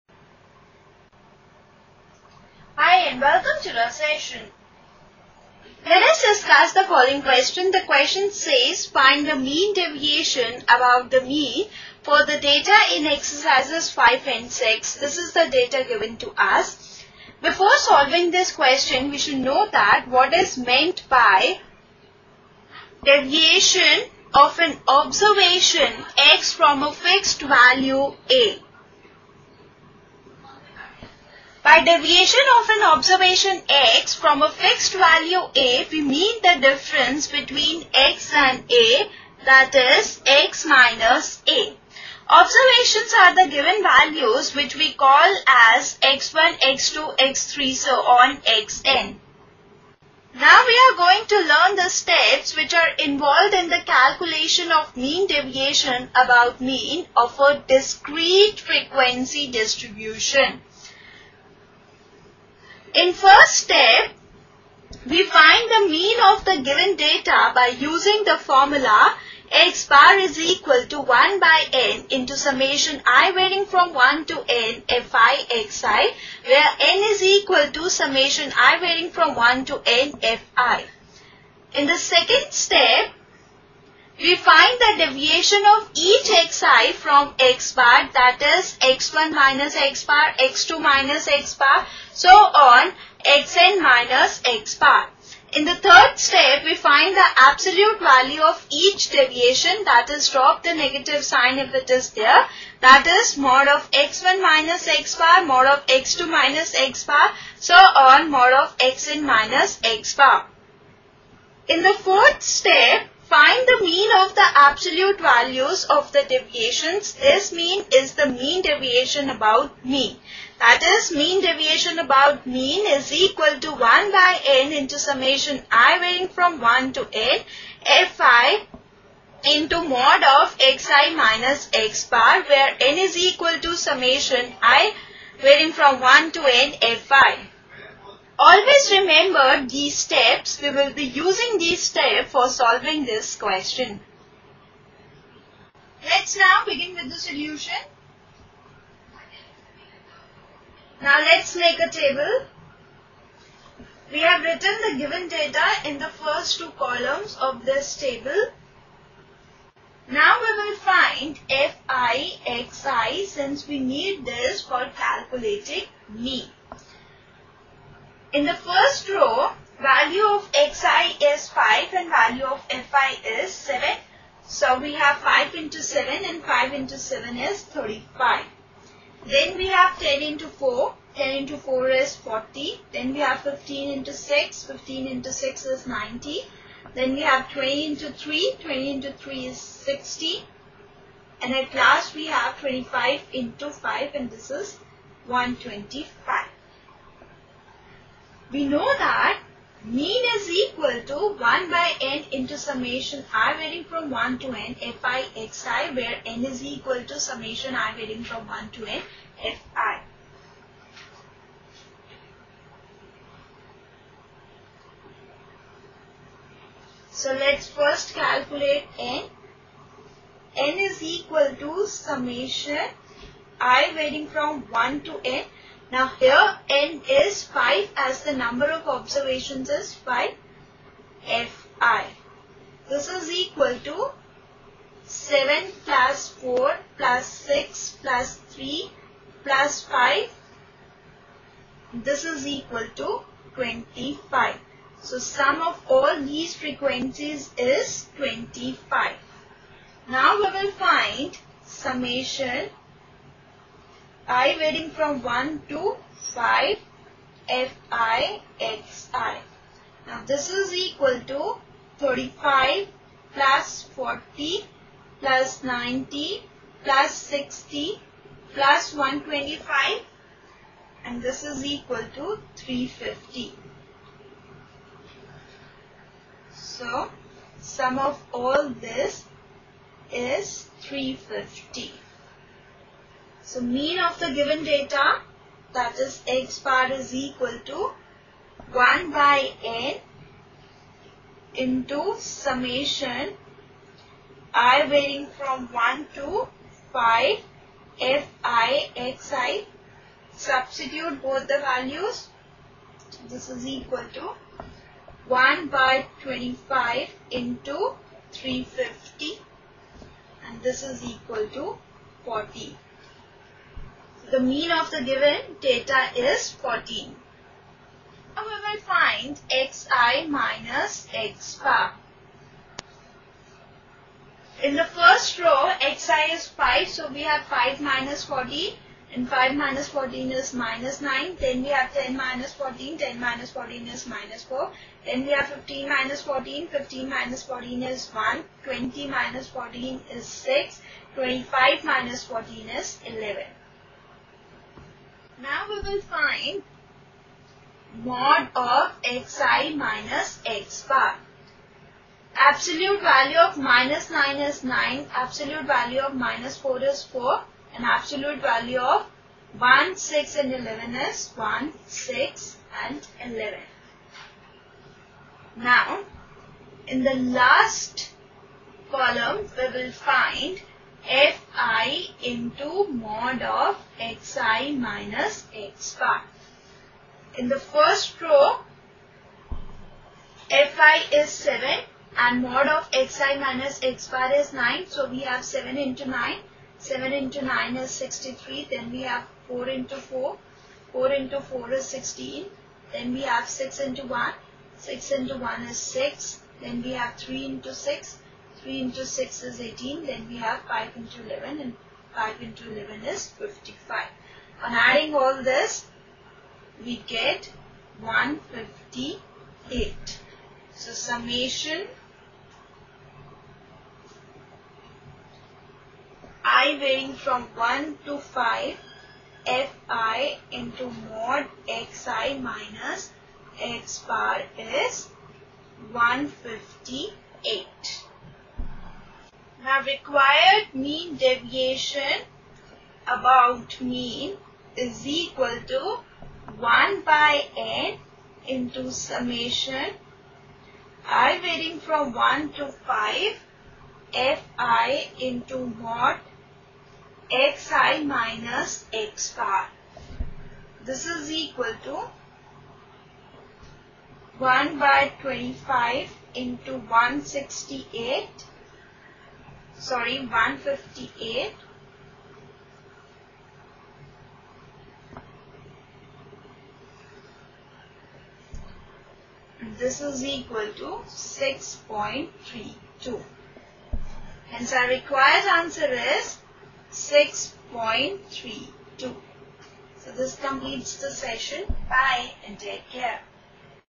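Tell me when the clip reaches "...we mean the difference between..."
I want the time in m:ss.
0:35.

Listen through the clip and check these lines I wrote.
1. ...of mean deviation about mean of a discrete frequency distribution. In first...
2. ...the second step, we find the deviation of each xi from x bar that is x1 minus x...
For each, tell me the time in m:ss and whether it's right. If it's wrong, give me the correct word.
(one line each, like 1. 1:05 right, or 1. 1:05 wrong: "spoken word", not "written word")
1. 0:54 right
2. 1:21 right.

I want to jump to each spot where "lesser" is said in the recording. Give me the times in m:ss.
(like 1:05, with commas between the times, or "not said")
not said.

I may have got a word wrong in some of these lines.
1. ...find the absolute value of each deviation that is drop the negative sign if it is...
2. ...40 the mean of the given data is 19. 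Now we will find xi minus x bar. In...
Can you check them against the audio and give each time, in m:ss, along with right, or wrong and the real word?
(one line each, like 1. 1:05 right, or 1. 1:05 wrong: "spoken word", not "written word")
1. 1:36 right
2. 5:12 wrong: "14", not "19".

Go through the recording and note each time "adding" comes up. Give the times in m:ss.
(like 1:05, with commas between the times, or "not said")
6:44.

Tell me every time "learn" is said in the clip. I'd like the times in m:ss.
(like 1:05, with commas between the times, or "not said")
0:51.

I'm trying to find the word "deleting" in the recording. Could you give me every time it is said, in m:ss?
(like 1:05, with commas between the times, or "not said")
not said.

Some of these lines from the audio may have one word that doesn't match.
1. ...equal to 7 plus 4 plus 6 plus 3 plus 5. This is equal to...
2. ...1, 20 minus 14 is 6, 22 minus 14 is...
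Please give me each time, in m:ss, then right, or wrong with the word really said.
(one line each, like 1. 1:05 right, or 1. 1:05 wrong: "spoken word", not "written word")
1. 3:53 right
2. 5:38 wrong: "25", not "22".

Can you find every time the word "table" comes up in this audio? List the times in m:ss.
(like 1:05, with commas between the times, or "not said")
2:31, 2:37.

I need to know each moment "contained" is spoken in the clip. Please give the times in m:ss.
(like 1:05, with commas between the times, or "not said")
not said.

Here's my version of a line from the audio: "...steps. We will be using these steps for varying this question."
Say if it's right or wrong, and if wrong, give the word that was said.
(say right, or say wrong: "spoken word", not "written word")
wrong: "solving", not "varying".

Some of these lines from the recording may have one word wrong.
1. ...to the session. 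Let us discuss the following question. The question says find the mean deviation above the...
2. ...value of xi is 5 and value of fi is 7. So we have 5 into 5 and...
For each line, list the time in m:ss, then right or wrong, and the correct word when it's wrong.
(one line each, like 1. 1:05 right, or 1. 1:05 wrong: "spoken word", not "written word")
1. 0:03 right
2. 2:49 wrong: "7", not "5".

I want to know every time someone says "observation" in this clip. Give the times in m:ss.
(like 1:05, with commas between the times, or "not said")
0:24, 0:32, 0:42, 3:48.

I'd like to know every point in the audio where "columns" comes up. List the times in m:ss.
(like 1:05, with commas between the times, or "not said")
2:36, 6:08.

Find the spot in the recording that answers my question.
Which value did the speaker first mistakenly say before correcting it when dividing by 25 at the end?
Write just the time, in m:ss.
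7:37.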